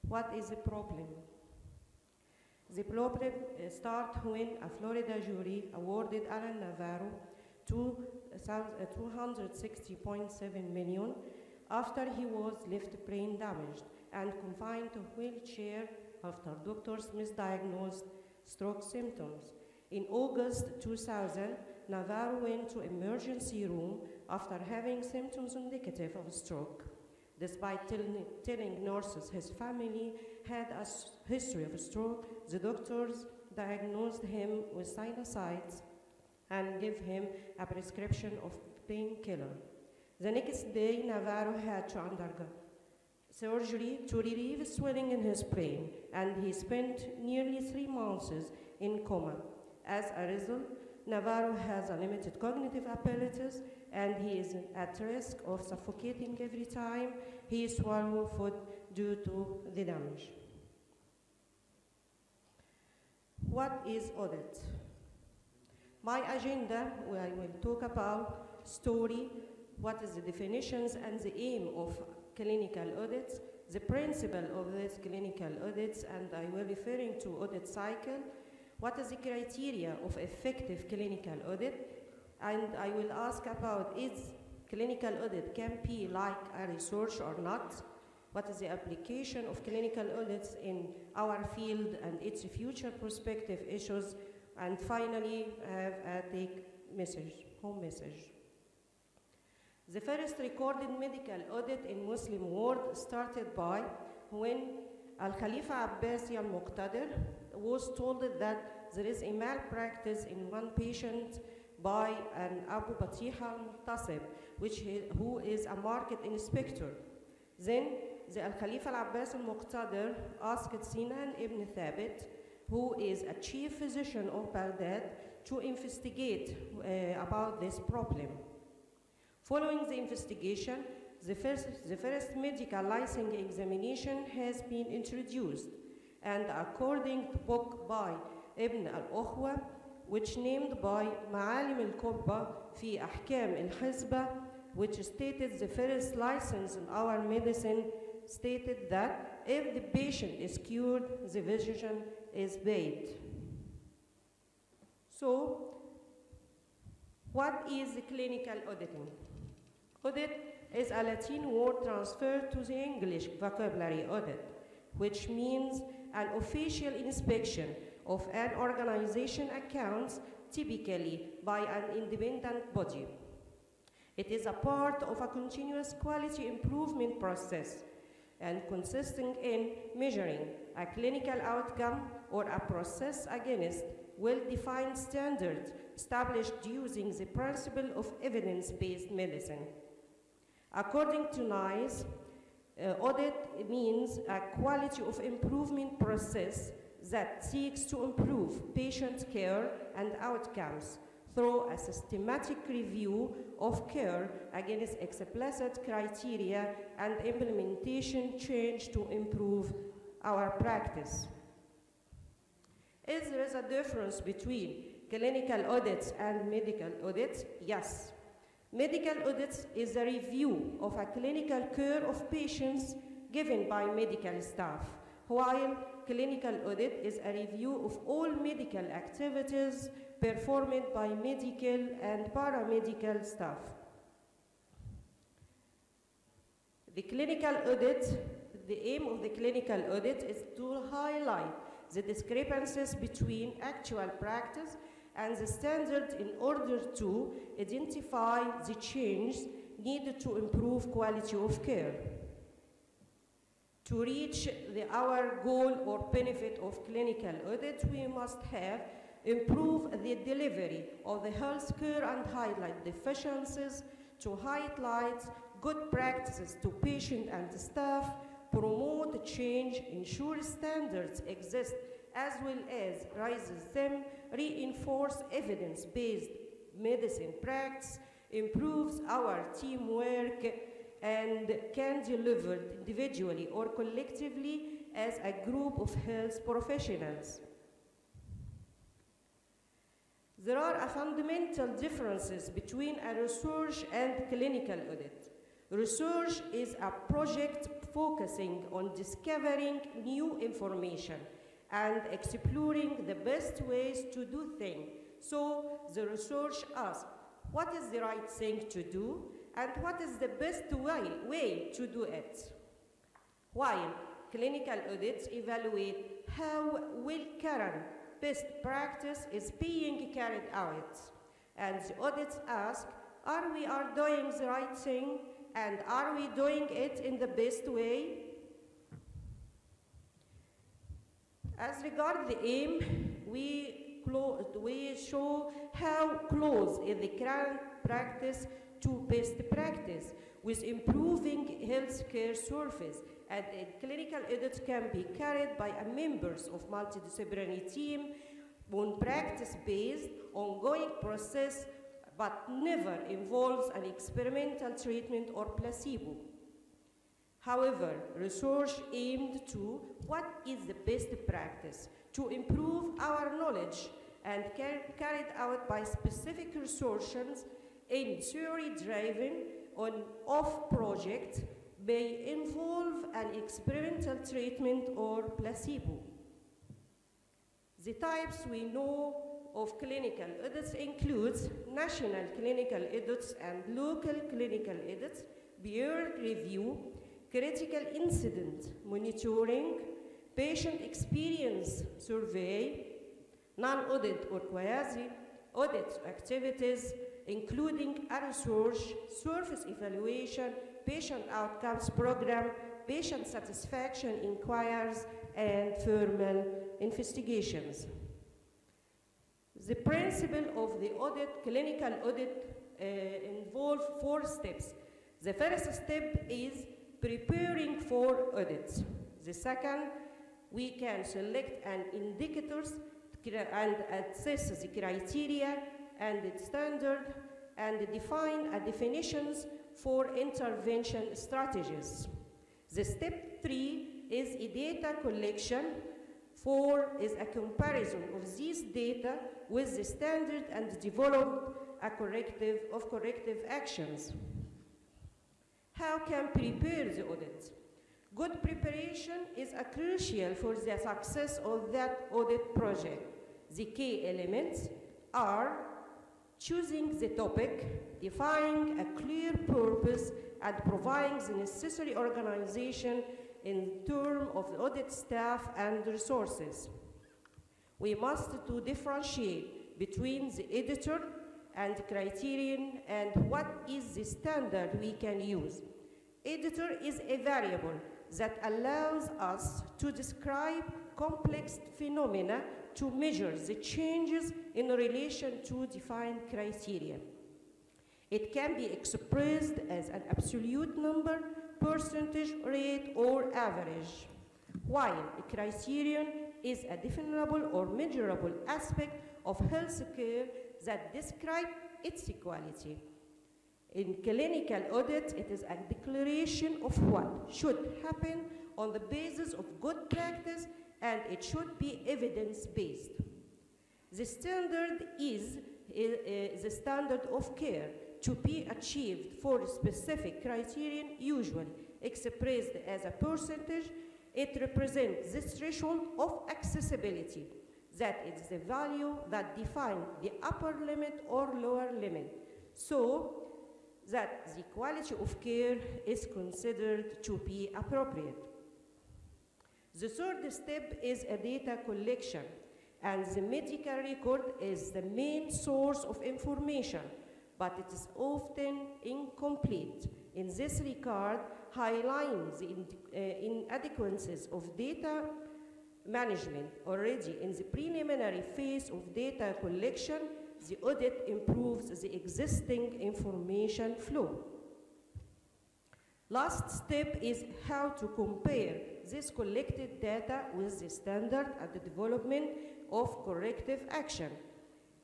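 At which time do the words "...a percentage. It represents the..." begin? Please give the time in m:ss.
8:42.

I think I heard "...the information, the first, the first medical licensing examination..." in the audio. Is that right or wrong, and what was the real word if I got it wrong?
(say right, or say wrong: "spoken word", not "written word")
wrong: "investigation", not "information".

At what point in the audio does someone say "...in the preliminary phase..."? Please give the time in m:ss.
9:17.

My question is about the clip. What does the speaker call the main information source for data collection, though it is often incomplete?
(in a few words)
The medical record.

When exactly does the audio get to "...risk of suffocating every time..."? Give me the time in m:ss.
0:55.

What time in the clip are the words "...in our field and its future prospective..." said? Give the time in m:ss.
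1:30.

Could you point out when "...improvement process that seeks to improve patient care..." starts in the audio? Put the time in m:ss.
3:15.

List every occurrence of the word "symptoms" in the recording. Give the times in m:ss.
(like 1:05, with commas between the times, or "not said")
0:18, 0:25.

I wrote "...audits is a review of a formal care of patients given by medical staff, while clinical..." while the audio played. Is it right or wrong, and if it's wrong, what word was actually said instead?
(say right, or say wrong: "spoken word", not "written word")
wrong: "clinical", not "formal".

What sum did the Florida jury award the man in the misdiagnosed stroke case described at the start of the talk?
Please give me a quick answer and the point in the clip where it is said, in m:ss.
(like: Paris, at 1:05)
$260.7 million, at 0:07.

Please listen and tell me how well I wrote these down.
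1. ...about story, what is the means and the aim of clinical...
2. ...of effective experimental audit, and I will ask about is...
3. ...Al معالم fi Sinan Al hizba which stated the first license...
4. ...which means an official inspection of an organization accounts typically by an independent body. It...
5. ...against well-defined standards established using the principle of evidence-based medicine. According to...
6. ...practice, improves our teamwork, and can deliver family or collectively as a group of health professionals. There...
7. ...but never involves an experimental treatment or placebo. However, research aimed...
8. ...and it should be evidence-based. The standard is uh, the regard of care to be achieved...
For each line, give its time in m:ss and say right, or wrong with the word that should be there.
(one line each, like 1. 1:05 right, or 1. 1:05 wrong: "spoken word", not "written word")
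1. 1:07 wrong: "definitions", not "means"
2. 1:19 wrong: "clinical", not "experimental"
3. 2:21 wrong: "Ahkam", not "Sinan"
4. 2:45 right
5. 3:03 right
6. 4:37 wrong: "individually", not "family"
7. 5:52 right
8. 8:30 wrong: "standard", not "regard".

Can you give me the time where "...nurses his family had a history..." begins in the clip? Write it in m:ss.
0:28.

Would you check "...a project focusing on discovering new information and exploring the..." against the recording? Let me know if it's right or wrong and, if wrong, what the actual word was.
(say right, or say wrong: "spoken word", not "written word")
right.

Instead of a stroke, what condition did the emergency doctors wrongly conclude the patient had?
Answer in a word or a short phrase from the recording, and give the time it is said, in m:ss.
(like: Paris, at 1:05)
Sinusitis, at 0:34.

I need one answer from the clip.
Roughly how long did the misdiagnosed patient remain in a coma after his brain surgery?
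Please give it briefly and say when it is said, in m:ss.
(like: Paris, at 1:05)
Nearly three months, at 0:47.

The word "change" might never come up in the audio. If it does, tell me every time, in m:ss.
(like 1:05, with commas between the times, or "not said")
3:28, 4:08, 4:29, 8:03.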